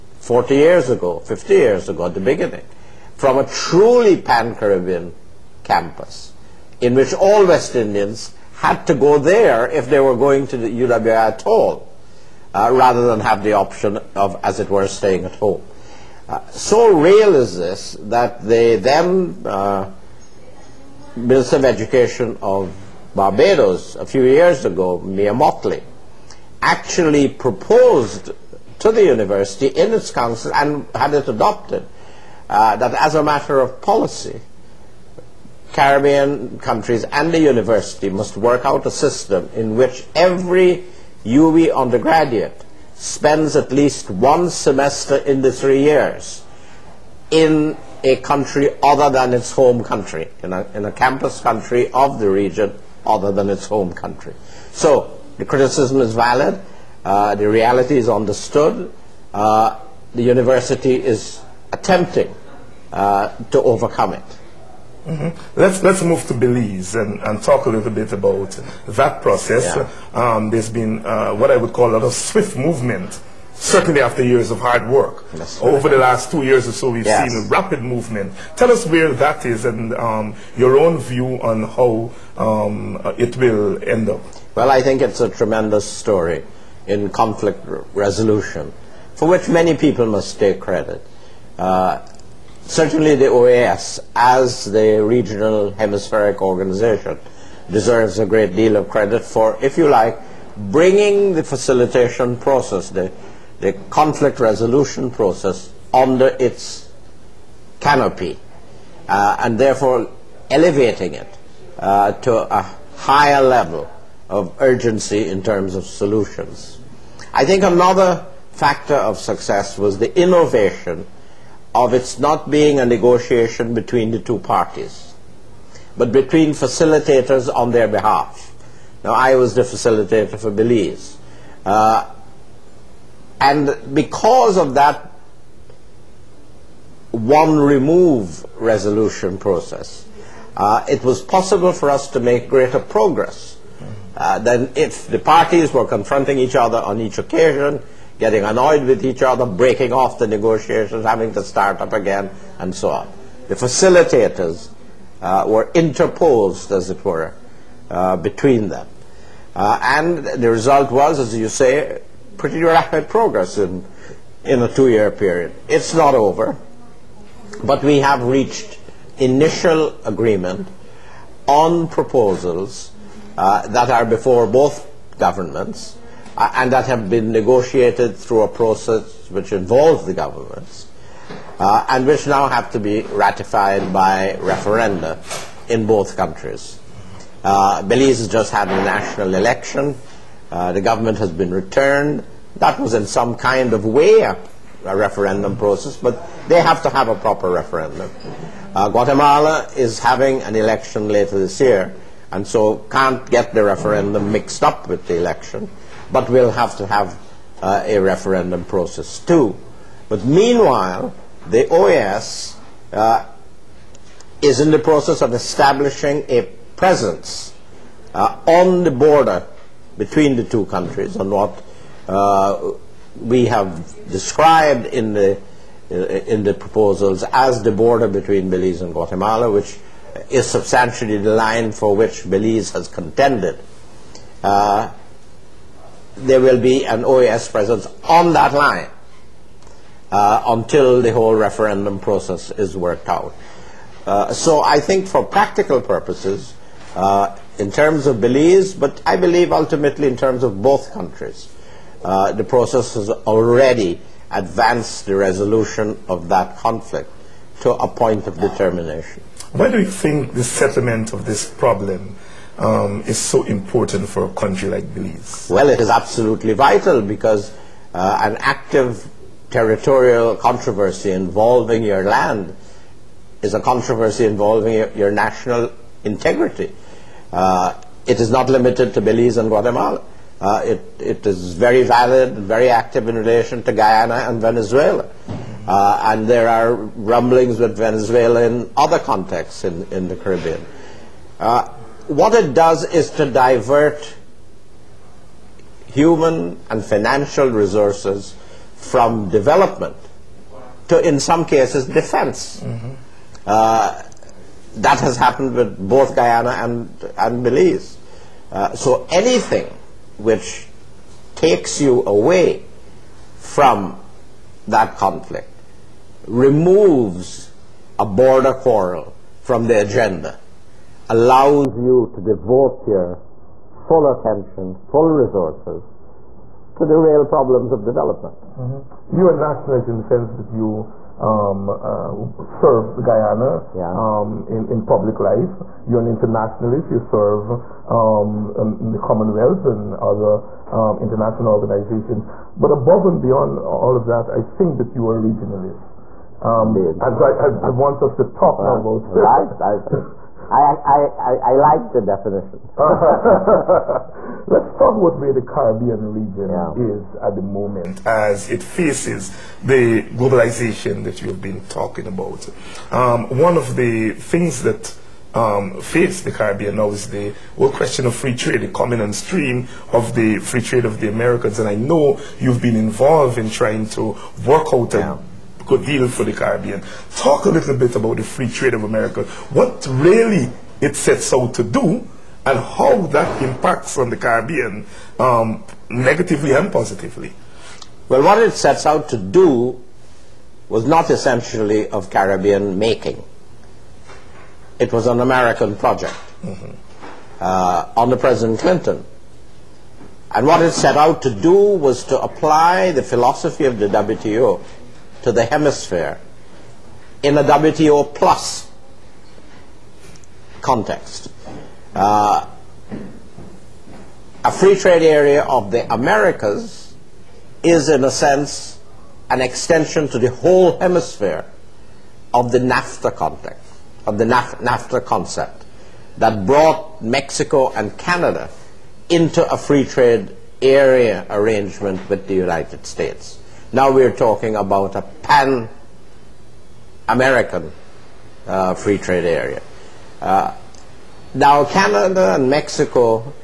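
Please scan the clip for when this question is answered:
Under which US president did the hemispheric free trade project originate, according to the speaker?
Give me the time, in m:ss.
6:38.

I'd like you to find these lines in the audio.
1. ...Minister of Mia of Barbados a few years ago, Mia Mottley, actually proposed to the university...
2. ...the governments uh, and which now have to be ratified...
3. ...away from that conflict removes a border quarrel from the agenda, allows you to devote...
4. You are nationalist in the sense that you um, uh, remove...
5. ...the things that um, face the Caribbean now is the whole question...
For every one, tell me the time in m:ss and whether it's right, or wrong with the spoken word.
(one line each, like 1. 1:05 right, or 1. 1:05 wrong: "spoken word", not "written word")
1. 0:21 wrong: "Education", not "Mia"
2. 3:00 right
3. 5:12 right
4. 5:29 wrong: "serve", not "remove"
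5. 6:03 right.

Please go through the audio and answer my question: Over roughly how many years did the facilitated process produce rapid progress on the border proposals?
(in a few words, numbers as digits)
2.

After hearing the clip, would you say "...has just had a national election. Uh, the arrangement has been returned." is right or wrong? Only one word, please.
wrong.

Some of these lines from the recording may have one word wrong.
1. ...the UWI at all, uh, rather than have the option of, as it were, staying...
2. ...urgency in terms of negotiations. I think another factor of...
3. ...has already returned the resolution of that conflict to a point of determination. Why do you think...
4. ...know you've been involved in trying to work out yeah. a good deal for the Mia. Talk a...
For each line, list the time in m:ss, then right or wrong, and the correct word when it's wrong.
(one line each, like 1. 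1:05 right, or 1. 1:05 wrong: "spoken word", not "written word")
1. 0:10 right
2. 1:54 wrong: "solutions", not "negotiations"
3. 4:12 wrong: "advanced", not "returned"
4. 6:11 wrong: "Caribbean", not "Mia".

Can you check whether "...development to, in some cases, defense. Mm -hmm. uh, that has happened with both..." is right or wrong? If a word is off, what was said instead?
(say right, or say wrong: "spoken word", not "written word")
right.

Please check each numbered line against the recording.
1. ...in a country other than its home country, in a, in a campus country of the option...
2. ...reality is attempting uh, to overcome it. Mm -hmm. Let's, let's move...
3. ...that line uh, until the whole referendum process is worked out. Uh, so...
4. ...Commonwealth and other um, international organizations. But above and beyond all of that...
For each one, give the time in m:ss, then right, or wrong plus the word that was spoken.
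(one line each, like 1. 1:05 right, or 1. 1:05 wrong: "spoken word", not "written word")
1. 0:47 wrong: "region", not "option"
2. 1:00 wrong: "university", not "reality"
3. 3:58 right
4. 5:38 right.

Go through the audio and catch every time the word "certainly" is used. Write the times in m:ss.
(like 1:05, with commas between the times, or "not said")
1:13, 1:32.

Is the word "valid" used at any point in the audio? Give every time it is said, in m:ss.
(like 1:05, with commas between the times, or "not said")
0:56, 4:41.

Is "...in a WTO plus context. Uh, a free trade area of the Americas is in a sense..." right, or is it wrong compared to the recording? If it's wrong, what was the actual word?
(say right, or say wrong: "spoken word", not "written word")
right.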